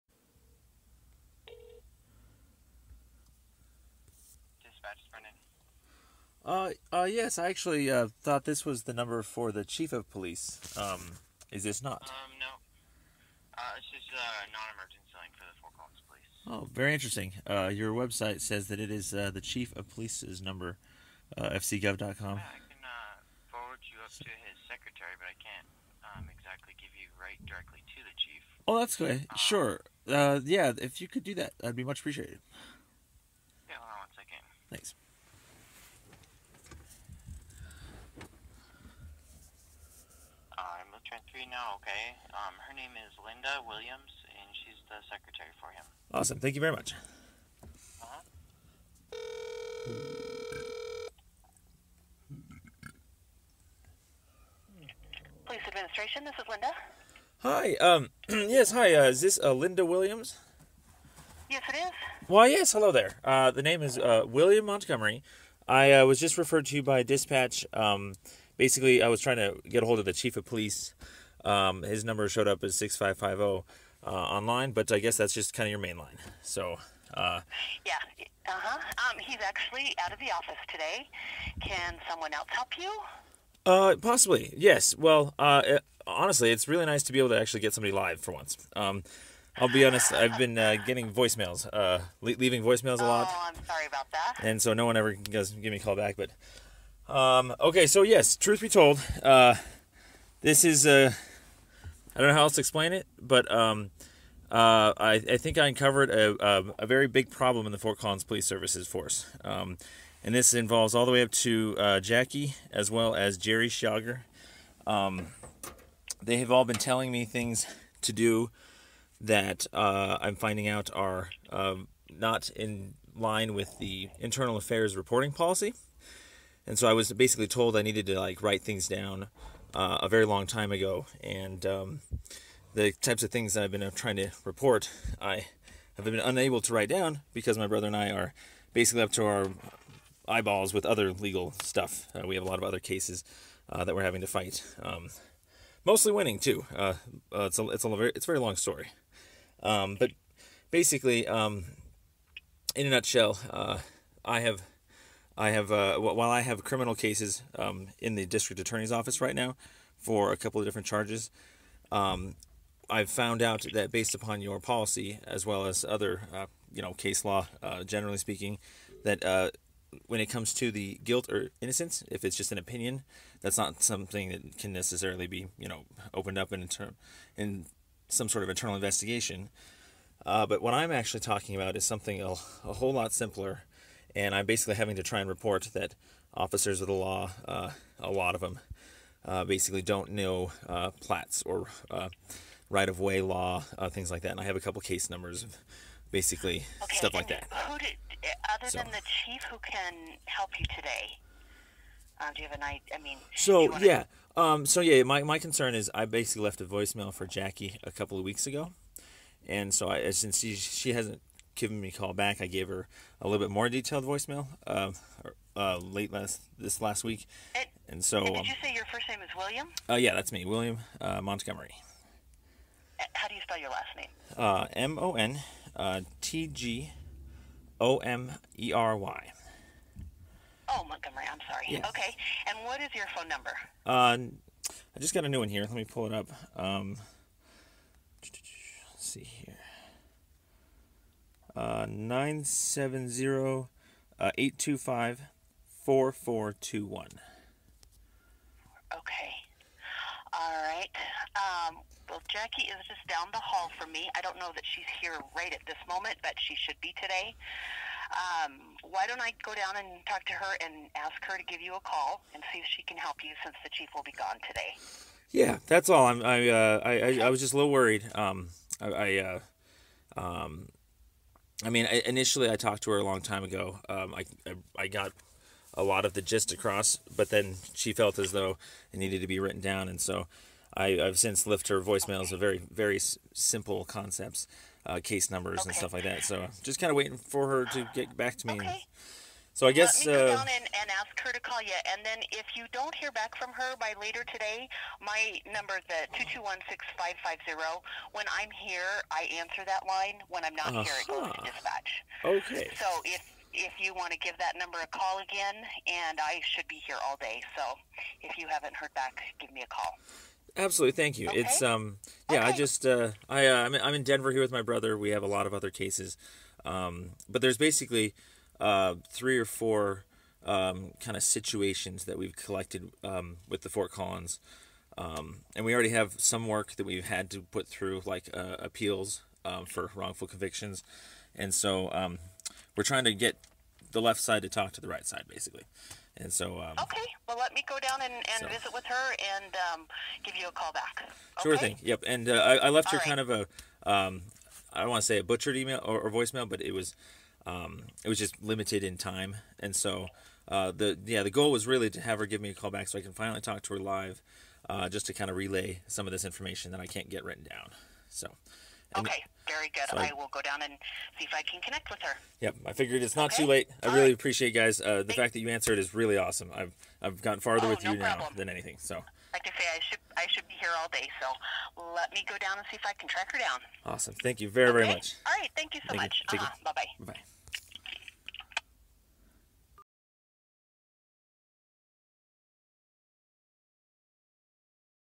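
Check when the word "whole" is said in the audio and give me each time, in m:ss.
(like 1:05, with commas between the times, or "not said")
3:02.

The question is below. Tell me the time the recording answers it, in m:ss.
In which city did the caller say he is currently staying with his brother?
5:14.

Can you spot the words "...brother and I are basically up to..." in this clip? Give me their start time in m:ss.
2:17.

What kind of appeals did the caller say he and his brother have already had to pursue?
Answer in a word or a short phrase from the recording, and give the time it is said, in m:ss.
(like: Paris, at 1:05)
wrongful convictions, at 5:29.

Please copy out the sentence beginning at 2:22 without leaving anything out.
Uh, we have a lot of other cases uh, that we're having to fight.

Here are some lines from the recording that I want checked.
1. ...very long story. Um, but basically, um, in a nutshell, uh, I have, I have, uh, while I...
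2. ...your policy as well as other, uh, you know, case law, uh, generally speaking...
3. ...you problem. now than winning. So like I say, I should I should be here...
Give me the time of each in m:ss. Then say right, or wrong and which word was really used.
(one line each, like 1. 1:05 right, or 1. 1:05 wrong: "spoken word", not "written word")
1. 2:28 right
2. 2:44 right
3. 6:07 wrong: "anything", not "winning".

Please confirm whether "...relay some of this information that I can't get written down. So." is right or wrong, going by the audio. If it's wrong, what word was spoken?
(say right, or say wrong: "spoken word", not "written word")
right.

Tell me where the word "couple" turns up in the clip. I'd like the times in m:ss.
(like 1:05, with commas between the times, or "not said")
2:40, 3:14, 3:27.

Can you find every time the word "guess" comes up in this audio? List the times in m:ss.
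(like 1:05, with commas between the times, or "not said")
1:14, 4:49.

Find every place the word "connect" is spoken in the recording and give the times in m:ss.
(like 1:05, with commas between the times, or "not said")
6:01.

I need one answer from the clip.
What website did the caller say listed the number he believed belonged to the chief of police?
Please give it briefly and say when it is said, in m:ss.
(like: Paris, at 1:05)
fcgov.com, at 0:21.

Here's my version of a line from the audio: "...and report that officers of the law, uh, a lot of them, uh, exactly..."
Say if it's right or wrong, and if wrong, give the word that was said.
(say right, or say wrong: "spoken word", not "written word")
wrong: "basically", not "exactly".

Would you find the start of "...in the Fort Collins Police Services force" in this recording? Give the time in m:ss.
1:47.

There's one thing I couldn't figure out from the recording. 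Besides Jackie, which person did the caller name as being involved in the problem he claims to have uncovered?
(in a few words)
Jerry Schauger.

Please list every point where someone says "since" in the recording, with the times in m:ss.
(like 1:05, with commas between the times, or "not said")
3:30, 4:23, 4:41.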